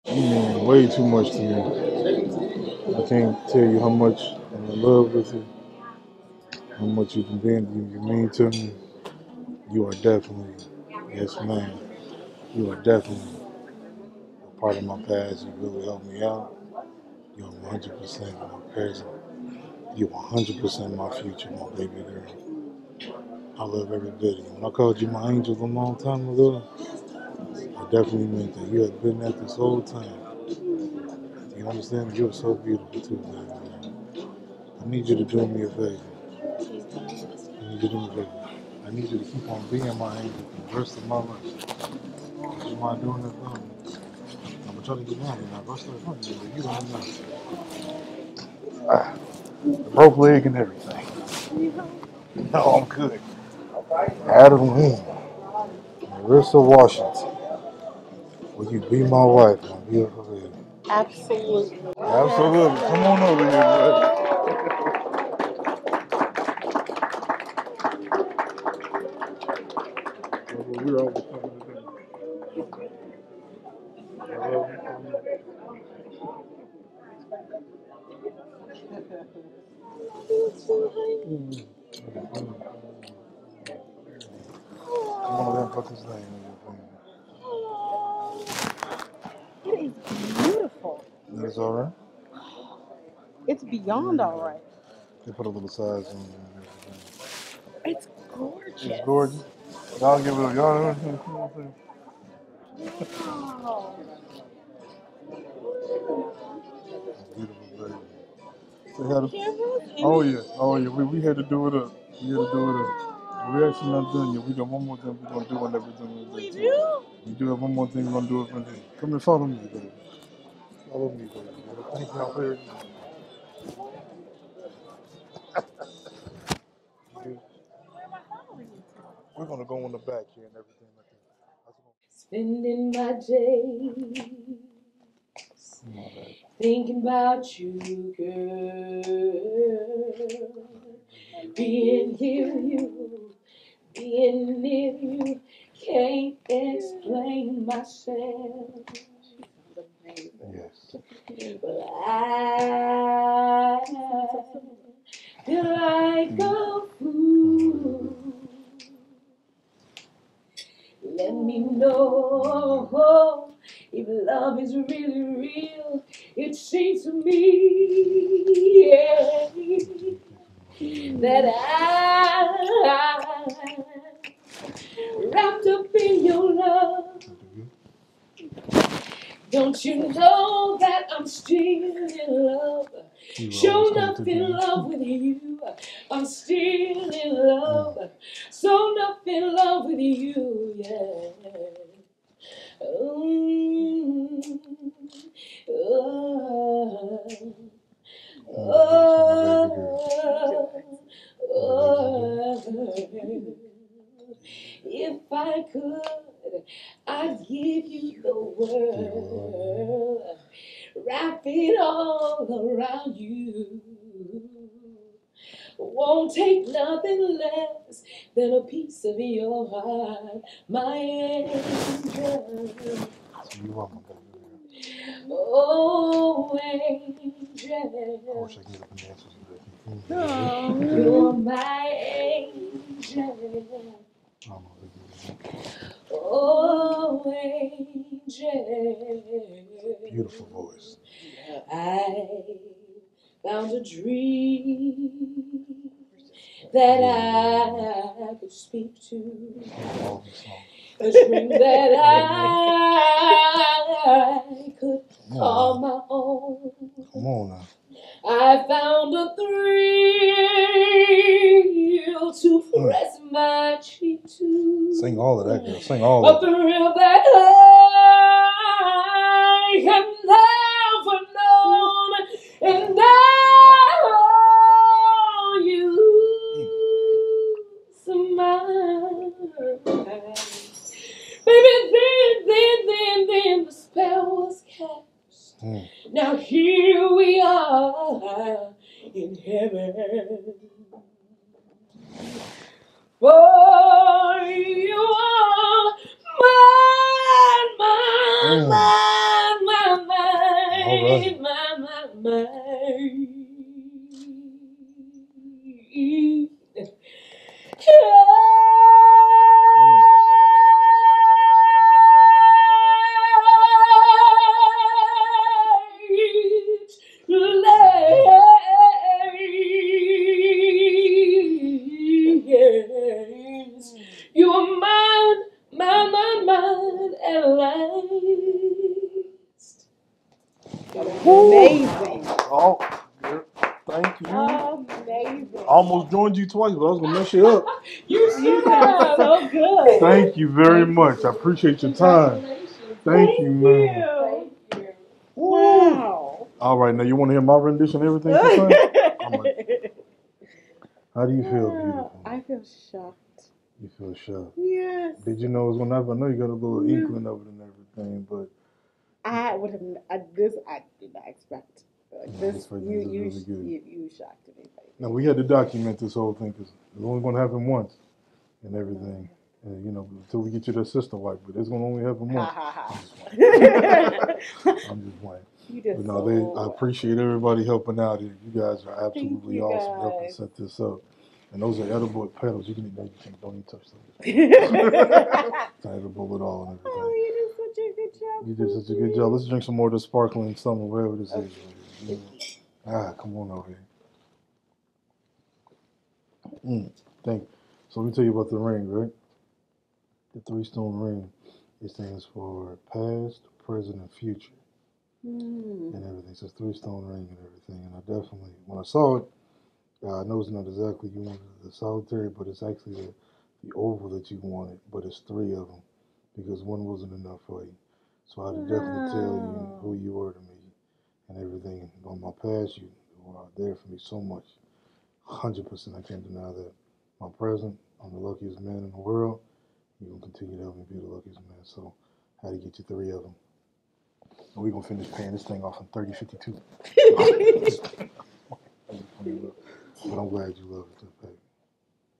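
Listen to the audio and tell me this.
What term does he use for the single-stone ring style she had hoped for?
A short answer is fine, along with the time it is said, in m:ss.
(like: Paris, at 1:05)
solitary, at 6:51.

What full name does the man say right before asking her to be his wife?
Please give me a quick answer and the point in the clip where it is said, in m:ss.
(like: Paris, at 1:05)
Marissa Washington, at 0:56.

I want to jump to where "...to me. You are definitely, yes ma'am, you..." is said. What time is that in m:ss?
0:08.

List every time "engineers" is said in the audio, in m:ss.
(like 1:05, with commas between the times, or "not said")
not said.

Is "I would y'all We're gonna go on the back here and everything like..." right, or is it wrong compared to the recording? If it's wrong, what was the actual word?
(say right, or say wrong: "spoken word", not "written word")
right.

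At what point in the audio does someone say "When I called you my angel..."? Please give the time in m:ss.
0:24.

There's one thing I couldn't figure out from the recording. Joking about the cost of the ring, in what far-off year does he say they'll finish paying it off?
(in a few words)
3052.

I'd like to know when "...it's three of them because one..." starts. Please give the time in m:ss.
6:55.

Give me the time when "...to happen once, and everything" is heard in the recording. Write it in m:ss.
6:07.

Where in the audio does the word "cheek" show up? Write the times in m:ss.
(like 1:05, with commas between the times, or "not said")
4:23.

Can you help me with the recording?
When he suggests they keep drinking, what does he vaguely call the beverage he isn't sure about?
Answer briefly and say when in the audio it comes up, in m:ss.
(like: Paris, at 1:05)
sparkling something, at 6:29.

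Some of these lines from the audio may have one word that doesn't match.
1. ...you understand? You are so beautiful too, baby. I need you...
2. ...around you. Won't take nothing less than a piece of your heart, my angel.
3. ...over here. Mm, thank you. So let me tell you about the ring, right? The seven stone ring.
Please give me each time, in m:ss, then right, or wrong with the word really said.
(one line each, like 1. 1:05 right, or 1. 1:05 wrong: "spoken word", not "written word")
1. 0:31 right
2. 3:32 right
3. 6:33 wrong: "three", not "seven".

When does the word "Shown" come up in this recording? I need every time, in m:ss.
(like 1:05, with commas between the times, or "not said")
3:03, 3:08.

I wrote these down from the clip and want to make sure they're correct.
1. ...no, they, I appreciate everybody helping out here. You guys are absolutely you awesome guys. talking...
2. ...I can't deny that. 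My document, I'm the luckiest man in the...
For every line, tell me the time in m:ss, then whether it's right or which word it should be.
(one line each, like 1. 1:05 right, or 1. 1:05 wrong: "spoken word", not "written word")
1. 6:15 wrong: "helping", not "talking"
2. 7:05 wrong: "present", not "document".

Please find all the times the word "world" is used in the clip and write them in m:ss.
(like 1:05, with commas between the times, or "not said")
3:28, 7:08.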